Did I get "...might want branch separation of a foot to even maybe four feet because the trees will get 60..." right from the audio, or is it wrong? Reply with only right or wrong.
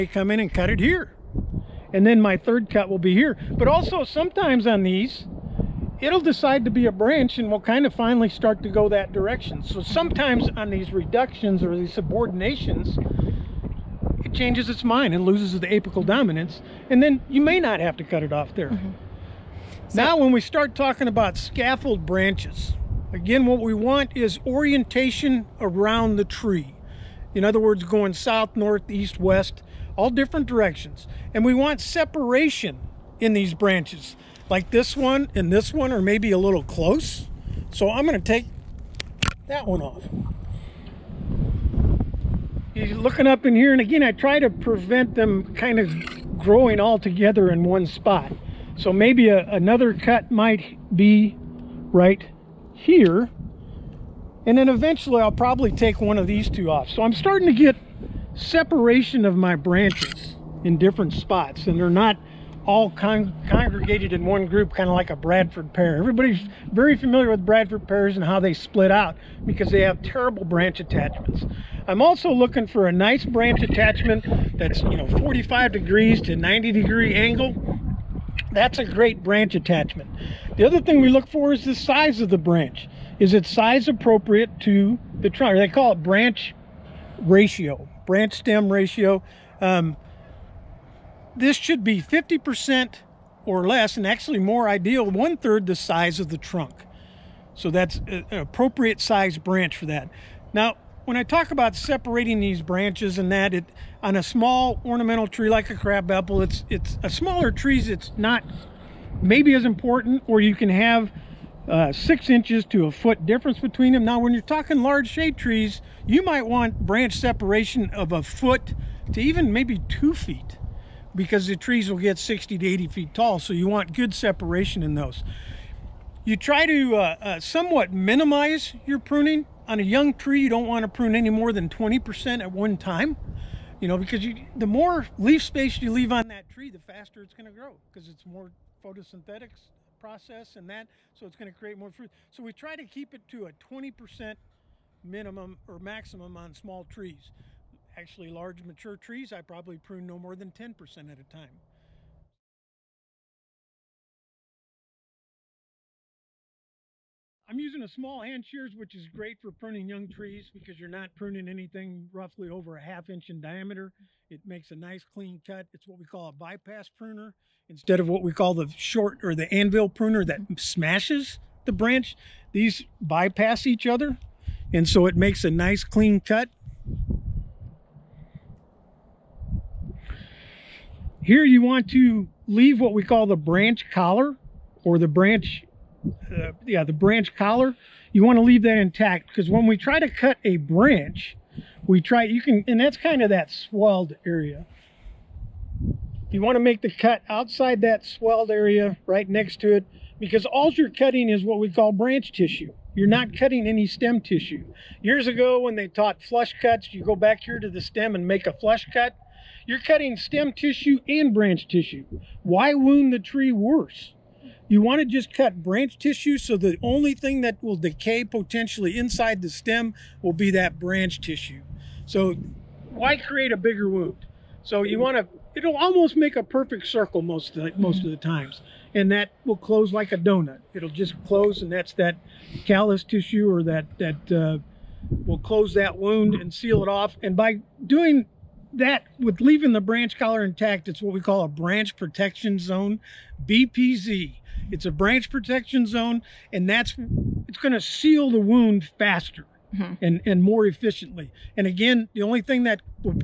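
wrong.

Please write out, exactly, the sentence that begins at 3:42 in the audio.
So why create a bigger wound?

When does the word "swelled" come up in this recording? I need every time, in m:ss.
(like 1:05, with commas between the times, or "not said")
3:13, 3:18.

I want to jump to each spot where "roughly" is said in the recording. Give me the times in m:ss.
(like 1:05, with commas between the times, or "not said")
2:42.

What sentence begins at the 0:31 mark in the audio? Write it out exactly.
And we want separation in these branches, like this one and this one are maybe a little close.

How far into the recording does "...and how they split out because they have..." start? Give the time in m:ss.
1:08.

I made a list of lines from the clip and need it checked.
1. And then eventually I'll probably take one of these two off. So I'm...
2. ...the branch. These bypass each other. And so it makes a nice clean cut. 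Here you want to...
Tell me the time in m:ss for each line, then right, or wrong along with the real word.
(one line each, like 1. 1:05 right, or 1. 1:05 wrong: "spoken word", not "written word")
1. 0:54 right
2. 2:51 right.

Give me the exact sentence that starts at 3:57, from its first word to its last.
And by doing that with leaving the branch collar intact, it's what we call a branch protection zone, BPZ.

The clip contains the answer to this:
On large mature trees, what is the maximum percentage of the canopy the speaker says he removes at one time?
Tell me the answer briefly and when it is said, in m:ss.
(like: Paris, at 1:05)
10%, at 2:30.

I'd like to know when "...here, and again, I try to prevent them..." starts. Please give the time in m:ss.
0:43.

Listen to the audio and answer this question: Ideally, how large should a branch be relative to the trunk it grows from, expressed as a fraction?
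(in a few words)
one third.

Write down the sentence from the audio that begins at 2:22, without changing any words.
So we try to keep it to a 20% minimum or maximum on small trees.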